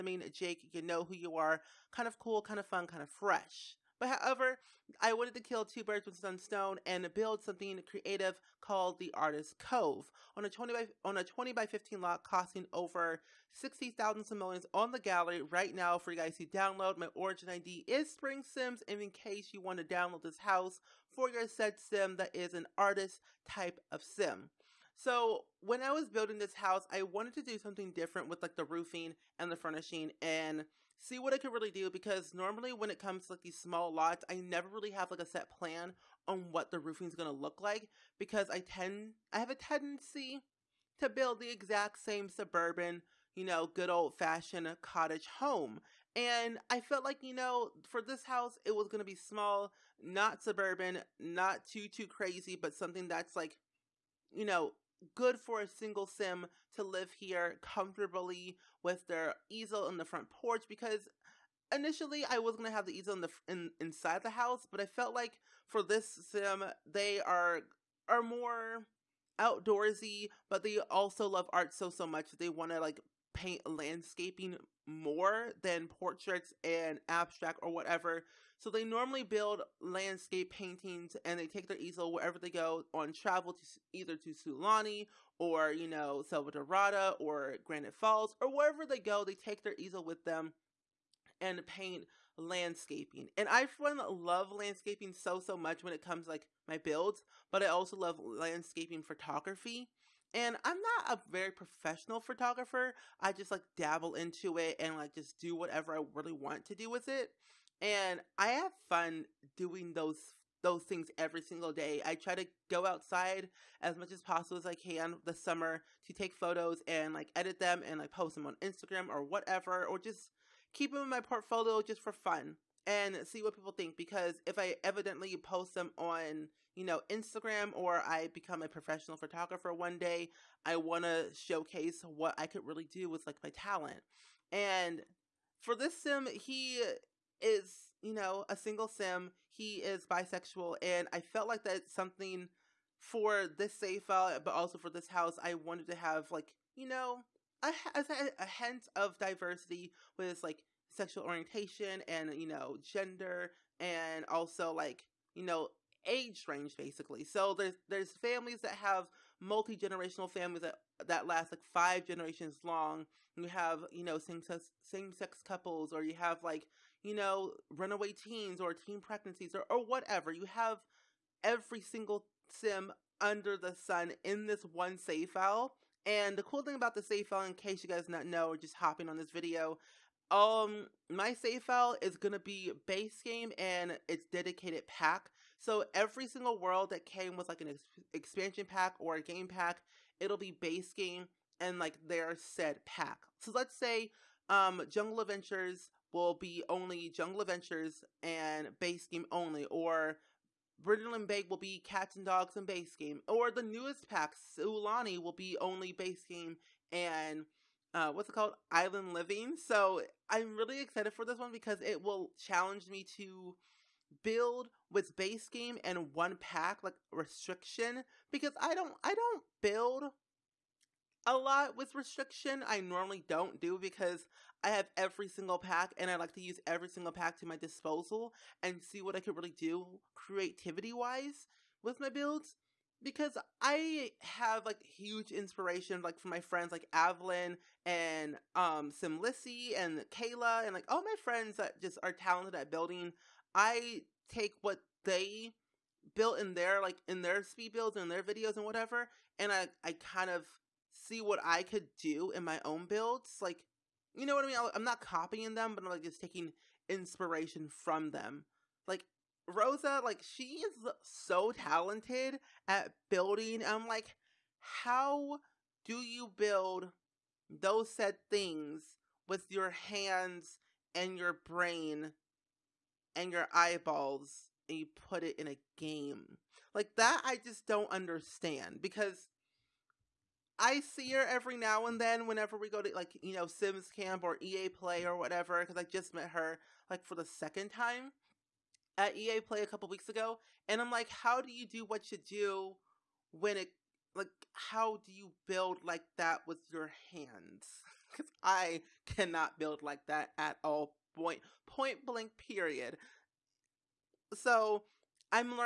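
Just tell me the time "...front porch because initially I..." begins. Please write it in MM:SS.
01:00.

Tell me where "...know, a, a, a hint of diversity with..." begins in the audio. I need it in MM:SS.
02:26.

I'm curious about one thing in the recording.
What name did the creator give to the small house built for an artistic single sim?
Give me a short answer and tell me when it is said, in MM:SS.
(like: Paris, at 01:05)
Artist Cove, at 00:09.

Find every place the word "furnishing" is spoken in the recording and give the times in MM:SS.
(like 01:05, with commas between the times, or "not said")
00:29.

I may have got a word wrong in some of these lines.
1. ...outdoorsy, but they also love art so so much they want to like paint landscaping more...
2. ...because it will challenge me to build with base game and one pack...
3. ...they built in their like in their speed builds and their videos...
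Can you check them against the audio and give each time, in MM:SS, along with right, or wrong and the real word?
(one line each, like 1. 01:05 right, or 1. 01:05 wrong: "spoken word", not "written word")
1. 01:09 right
2. 03:31 right
3. 04:05 right.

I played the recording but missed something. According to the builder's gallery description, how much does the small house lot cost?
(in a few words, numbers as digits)
Over 60,000 simoleons.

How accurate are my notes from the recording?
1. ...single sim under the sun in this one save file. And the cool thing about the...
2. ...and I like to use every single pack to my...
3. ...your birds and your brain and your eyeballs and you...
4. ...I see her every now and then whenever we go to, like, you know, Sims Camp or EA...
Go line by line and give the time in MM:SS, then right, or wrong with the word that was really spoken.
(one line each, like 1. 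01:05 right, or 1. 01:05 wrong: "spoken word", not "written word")
1. 02:51 right
2. 03:45 right
3. 04:29 wrong: "hands", not "birds"
4. 04:40 right.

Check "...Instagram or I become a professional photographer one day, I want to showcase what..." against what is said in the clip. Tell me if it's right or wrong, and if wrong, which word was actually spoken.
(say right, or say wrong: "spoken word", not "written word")
right.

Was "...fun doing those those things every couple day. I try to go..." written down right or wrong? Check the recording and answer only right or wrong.
wrong.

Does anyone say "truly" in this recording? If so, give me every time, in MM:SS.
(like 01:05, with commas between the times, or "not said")
not said.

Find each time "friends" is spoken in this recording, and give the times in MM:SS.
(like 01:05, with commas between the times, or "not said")
03:56, 04:01.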